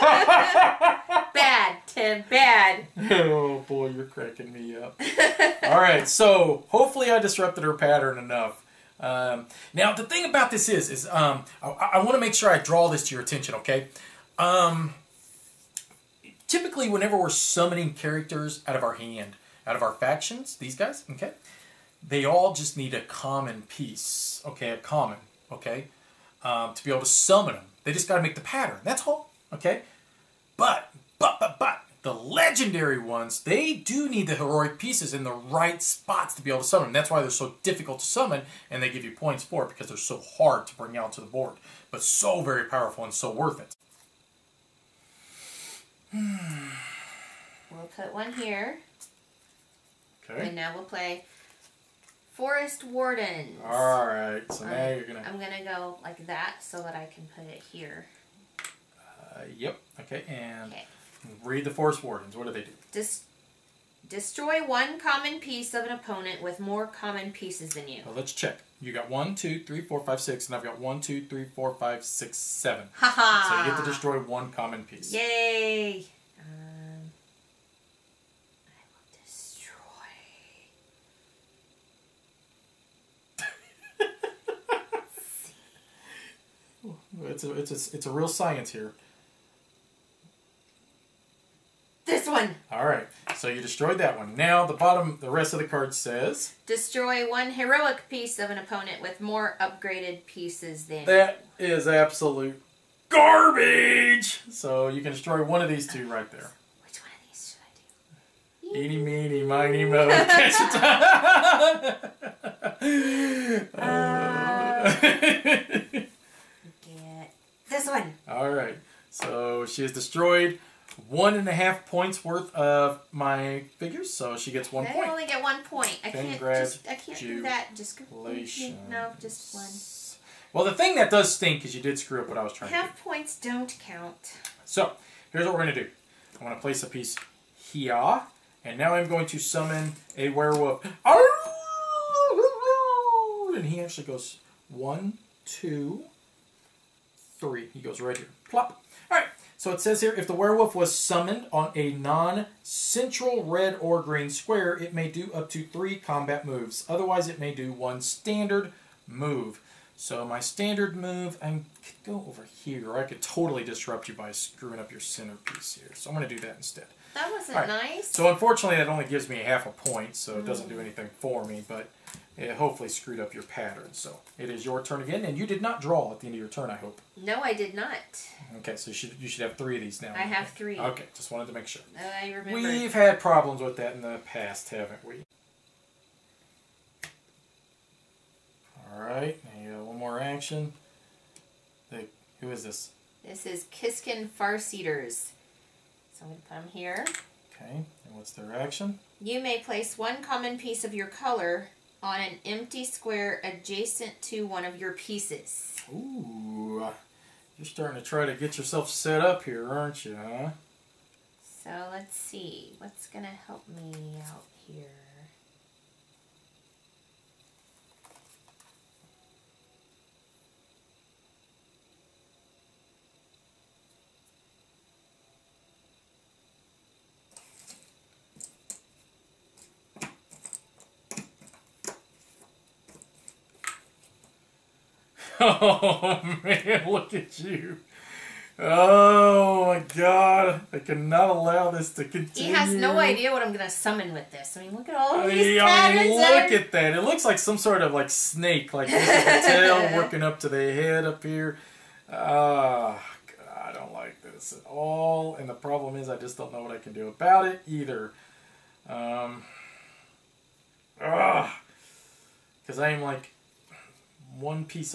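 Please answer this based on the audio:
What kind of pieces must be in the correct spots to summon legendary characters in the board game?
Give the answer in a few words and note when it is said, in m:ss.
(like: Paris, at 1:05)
Heroic pieces, at 0:34.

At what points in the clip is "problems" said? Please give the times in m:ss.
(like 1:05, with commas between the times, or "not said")
3:03, 4:15.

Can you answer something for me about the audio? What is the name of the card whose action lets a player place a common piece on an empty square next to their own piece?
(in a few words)
Kiskin Farseaters.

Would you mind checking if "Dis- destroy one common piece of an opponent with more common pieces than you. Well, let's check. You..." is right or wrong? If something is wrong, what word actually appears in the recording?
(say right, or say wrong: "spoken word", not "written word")
right.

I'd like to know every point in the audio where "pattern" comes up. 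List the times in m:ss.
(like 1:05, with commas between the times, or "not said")
0:07, 0:28, 2:53, 4:05.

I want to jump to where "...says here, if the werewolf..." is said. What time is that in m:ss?
2:29.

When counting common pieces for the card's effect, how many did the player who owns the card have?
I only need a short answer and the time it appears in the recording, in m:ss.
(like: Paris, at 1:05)
7, at 1:12.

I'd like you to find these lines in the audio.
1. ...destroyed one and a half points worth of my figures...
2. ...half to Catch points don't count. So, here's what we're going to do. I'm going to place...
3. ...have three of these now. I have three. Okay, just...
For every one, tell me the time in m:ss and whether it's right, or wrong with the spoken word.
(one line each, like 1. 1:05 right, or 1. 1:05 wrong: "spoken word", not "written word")
1. 1:59 right
2. 2:12 wrong: "Half", not "Catch"
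3. 2:59 right.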